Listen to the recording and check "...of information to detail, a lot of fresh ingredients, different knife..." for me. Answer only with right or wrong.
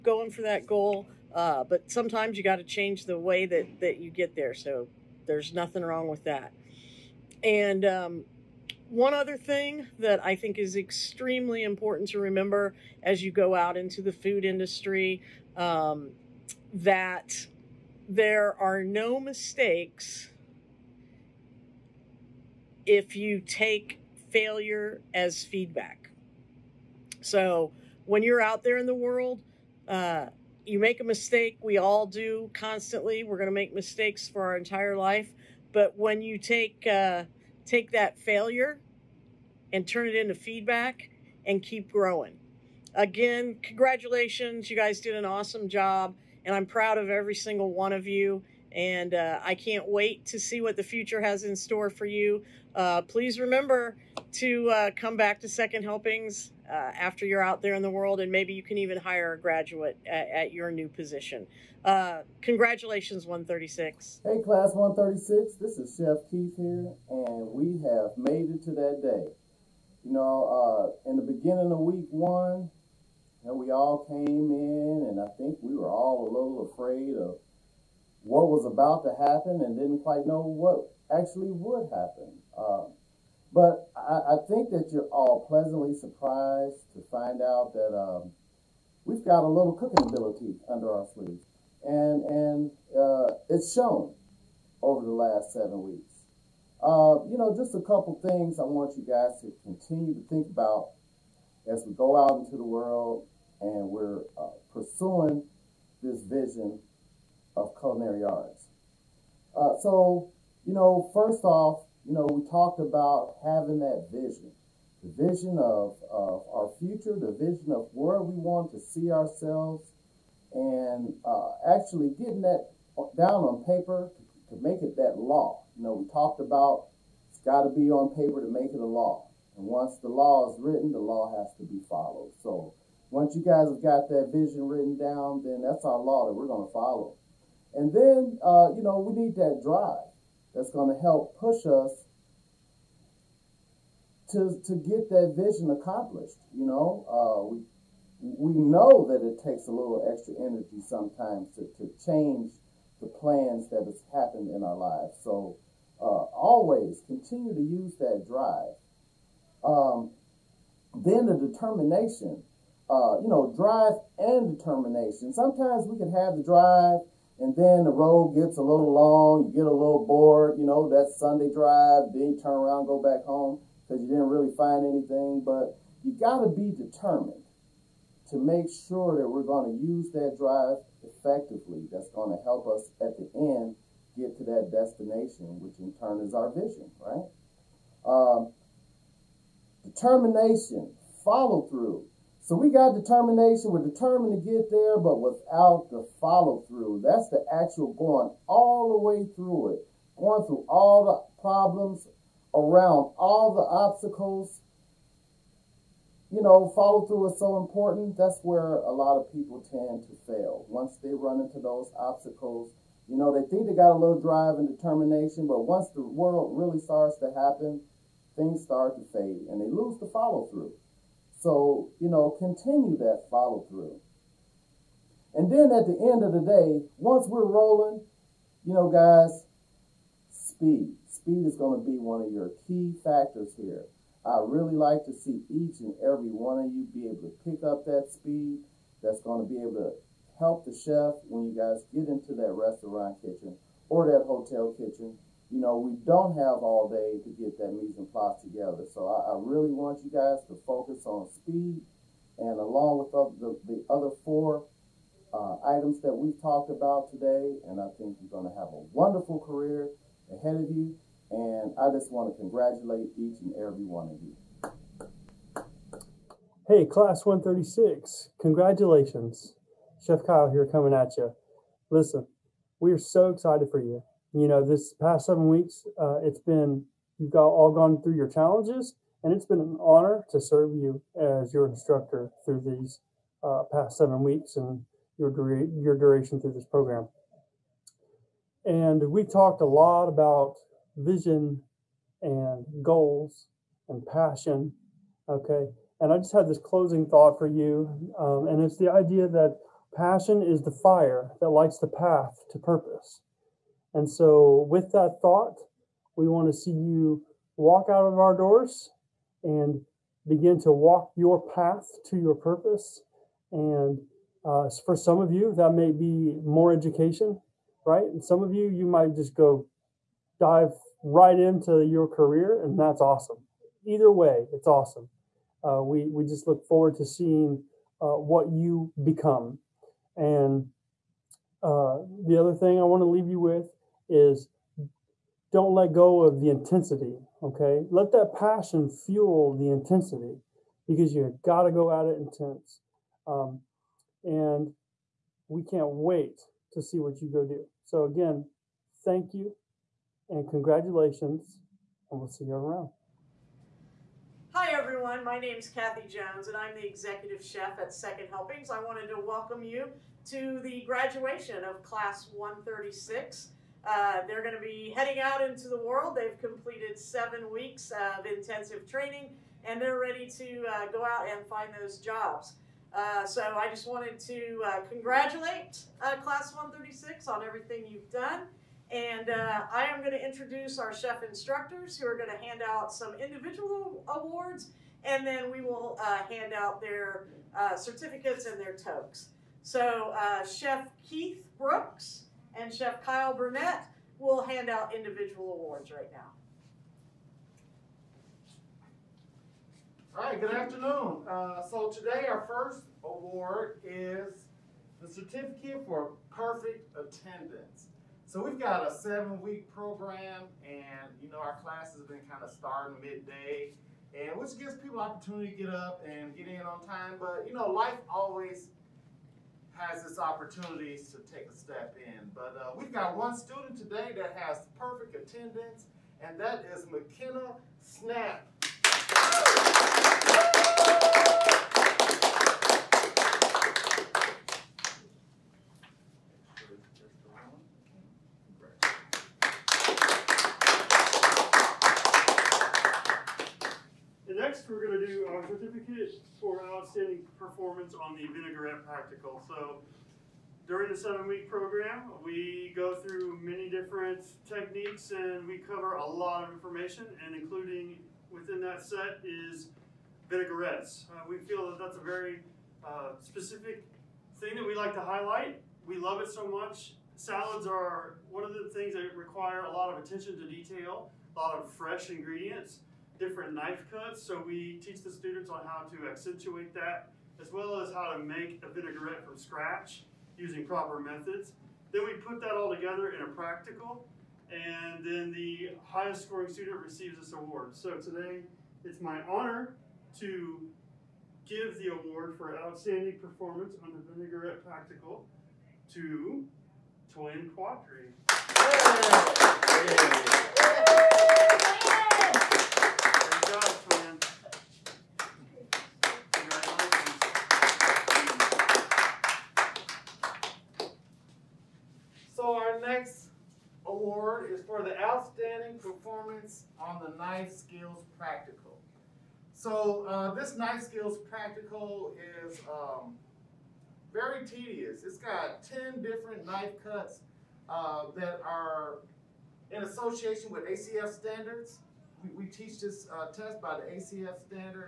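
wrong.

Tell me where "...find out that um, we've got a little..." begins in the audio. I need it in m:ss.
1:27.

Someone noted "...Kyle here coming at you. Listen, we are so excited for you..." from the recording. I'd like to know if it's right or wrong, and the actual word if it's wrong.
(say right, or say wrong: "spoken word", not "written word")
right.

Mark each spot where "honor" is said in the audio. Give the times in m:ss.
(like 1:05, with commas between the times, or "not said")
4:39, 8:09.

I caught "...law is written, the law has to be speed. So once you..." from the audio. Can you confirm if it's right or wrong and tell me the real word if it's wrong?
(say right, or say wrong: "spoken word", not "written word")
wrong: "followed", not "speed".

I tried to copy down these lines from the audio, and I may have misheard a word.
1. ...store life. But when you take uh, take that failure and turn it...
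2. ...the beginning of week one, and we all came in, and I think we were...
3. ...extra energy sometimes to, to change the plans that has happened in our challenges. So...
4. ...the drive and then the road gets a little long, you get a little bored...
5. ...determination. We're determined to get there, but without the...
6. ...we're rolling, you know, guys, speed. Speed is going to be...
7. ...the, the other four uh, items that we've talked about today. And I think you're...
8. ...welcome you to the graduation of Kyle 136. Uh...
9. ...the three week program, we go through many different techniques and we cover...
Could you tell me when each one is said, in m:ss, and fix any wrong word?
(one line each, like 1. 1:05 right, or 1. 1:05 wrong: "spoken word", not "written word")
1. 0:34 wrong: "entire", not "store"
2. 1:11 right
3. 2:30 wrong: "lives", not "challenges"
4. 2:46 right
5. 3:12 right
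6. 3:47 right
7. 4:13 right
8. 5:59 wrong: "Class", not "Kyle"
9. 7:30 wrong: "seven", not "three".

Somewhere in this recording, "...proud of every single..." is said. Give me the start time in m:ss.
0:46.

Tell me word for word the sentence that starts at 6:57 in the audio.
But you know life always has this opportunity to take a step in.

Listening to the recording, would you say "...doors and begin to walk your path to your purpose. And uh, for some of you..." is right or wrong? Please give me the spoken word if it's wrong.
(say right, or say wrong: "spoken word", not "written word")
right.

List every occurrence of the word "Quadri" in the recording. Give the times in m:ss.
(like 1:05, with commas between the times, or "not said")
8:17.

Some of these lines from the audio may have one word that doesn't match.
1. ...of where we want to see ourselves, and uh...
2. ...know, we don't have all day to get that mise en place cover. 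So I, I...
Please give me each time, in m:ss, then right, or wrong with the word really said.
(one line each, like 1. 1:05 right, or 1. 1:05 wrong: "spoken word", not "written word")
1. 1:57 right
2. 4:05 wrong: "together", not "cover".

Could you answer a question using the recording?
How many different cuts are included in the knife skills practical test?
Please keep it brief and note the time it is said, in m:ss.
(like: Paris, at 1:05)
10, at 8:45.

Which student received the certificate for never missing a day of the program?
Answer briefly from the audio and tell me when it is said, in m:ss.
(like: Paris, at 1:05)
McKenna Snap, at 7:06.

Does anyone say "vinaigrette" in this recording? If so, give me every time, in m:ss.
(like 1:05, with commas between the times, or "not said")
7:28, 7:40, 7:58, 8:14.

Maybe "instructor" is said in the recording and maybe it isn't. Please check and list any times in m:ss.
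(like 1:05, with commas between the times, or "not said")
4:41, 6:21.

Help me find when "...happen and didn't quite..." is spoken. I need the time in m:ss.
1:19.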